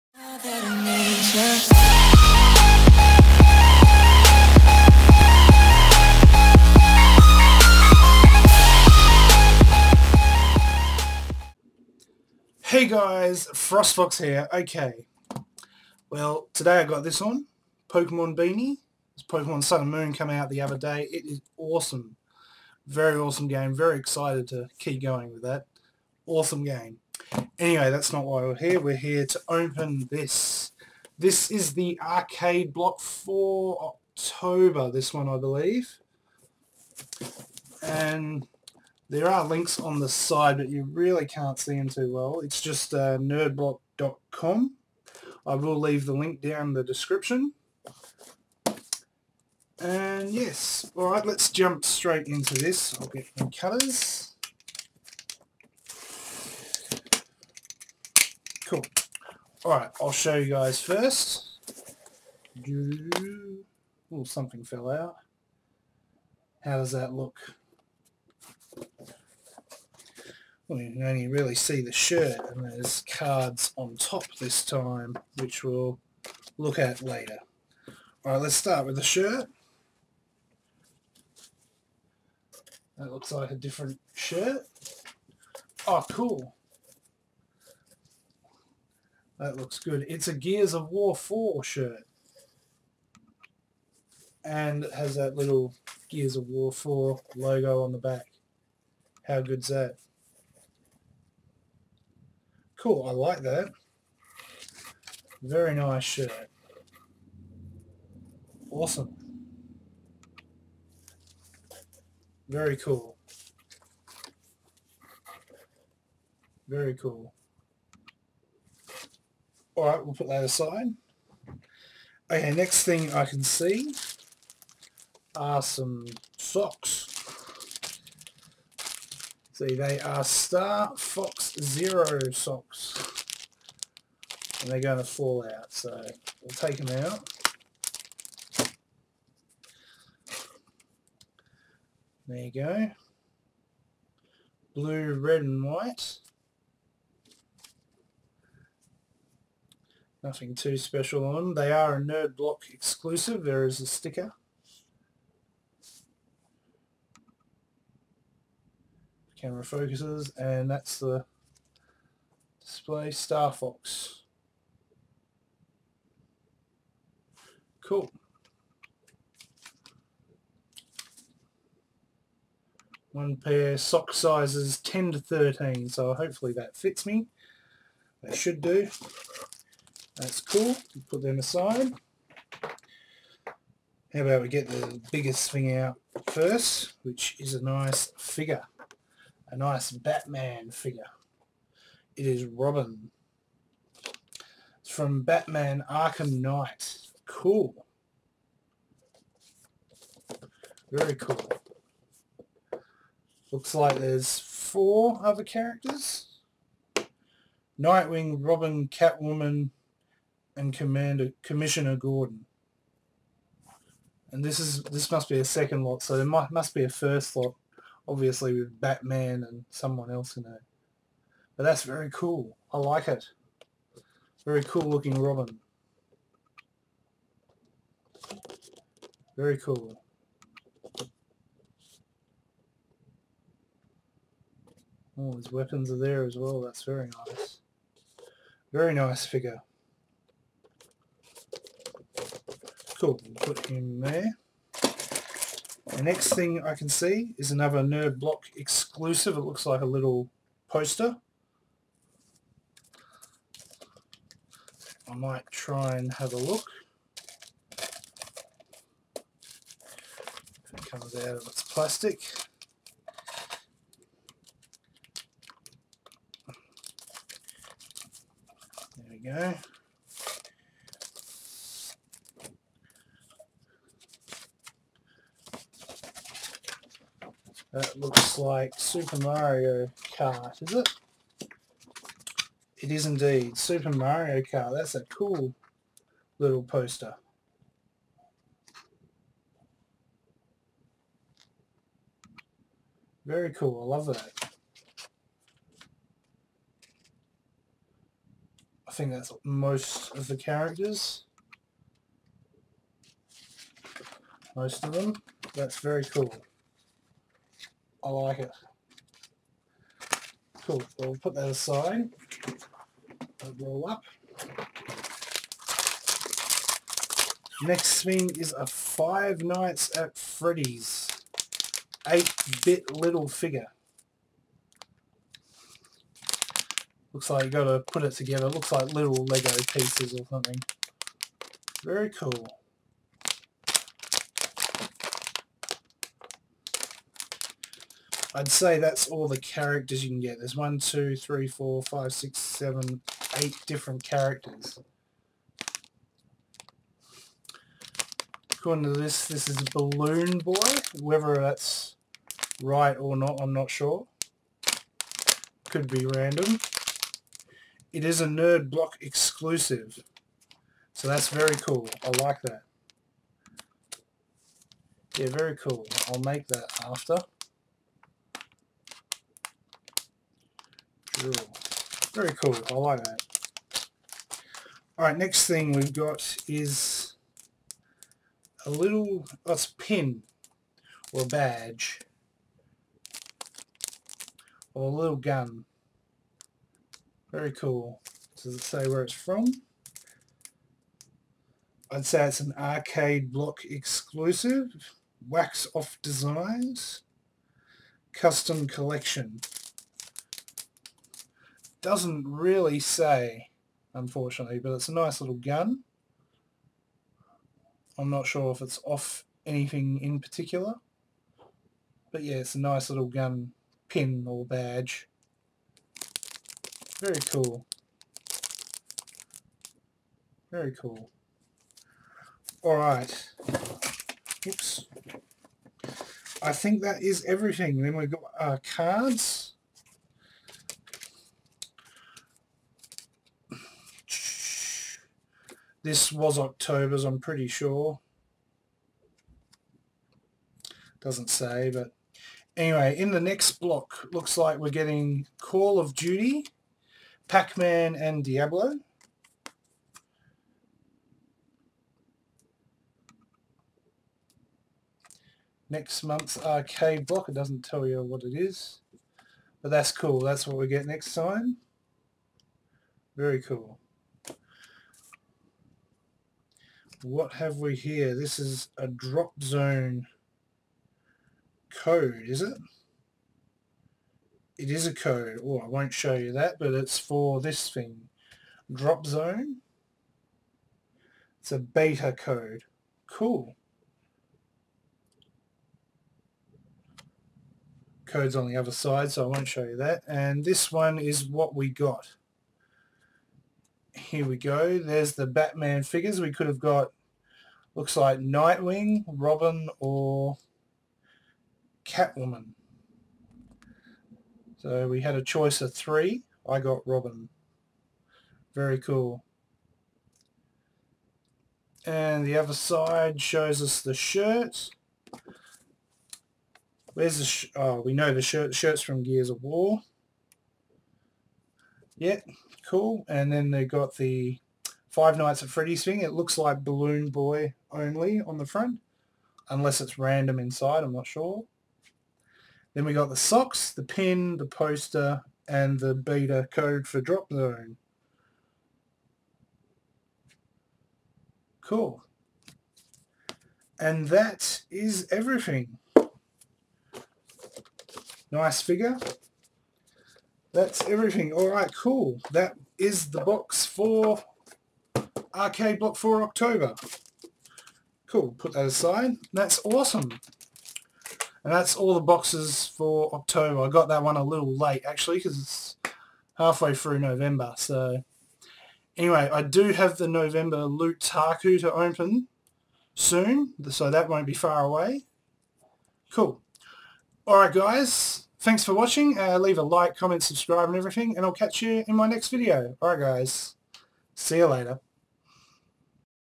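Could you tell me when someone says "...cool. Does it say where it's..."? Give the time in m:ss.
6:27.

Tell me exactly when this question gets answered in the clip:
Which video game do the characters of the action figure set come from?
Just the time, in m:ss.
3:15.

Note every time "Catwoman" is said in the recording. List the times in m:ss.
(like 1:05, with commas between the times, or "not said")
3:28, 8:21.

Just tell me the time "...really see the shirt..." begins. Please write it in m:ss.
1:11.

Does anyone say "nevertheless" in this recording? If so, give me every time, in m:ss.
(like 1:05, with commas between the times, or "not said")
not said.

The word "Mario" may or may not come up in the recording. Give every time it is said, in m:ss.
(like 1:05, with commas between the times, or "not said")
4:39, 4:43.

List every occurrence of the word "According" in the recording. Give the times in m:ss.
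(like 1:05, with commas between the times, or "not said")
5:48.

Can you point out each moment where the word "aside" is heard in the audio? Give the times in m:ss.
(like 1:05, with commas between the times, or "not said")
2:00, 3:01, 5:11, 9:18.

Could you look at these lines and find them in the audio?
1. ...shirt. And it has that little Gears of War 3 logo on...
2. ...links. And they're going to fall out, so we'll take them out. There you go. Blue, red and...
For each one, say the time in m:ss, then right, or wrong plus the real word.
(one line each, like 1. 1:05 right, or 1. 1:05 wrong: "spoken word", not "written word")
1. 1:31 wrong: "4", not "3"
2. 2:12 wrong: "socks", not "links".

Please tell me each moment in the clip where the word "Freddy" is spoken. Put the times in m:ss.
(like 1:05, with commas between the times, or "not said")
5:20, 8:45.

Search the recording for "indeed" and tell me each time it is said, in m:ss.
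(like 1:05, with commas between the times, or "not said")
4:43.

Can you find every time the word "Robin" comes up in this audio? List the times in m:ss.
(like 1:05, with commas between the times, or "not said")
3:12, 3:28, 3:45, 8:19, 8:26.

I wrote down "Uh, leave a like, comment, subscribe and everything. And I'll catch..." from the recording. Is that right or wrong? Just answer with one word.
right.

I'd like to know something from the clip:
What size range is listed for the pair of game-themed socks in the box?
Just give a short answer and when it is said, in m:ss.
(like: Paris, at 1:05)
10 to 13, at 2:54.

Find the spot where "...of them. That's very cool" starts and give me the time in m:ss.
5:04.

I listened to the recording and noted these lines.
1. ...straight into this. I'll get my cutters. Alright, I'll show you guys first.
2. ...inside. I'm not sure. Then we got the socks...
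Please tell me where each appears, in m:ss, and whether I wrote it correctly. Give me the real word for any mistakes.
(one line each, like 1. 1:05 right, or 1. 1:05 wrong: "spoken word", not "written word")
1. 0:51 right
2. 8:50 right.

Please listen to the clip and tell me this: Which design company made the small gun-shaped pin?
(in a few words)
Wax off designs.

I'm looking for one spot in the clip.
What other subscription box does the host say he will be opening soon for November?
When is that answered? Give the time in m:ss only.
9:30.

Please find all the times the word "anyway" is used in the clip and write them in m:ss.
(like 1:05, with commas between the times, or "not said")
0:27, 7:22, 9:28.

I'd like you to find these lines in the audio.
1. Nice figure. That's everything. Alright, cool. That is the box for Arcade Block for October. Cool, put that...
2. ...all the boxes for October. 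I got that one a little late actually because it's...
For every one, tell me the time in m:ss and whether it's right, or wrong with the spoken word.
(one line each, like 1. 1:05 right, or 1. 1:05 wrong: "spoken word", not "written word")
1. 9:08 right
2. 9:21 right.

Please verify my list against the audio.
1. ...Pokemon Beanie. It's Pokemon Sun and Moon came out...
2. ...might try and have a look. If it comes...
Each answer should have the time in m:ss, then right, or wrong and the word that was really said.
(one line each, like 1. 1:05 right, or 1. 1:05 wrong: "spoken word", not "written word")
1. 0:17 right
2. 4:15 right.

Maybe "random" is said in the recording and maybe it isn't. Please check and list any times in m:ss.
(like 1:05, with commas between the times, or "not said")
5:56, 8:49.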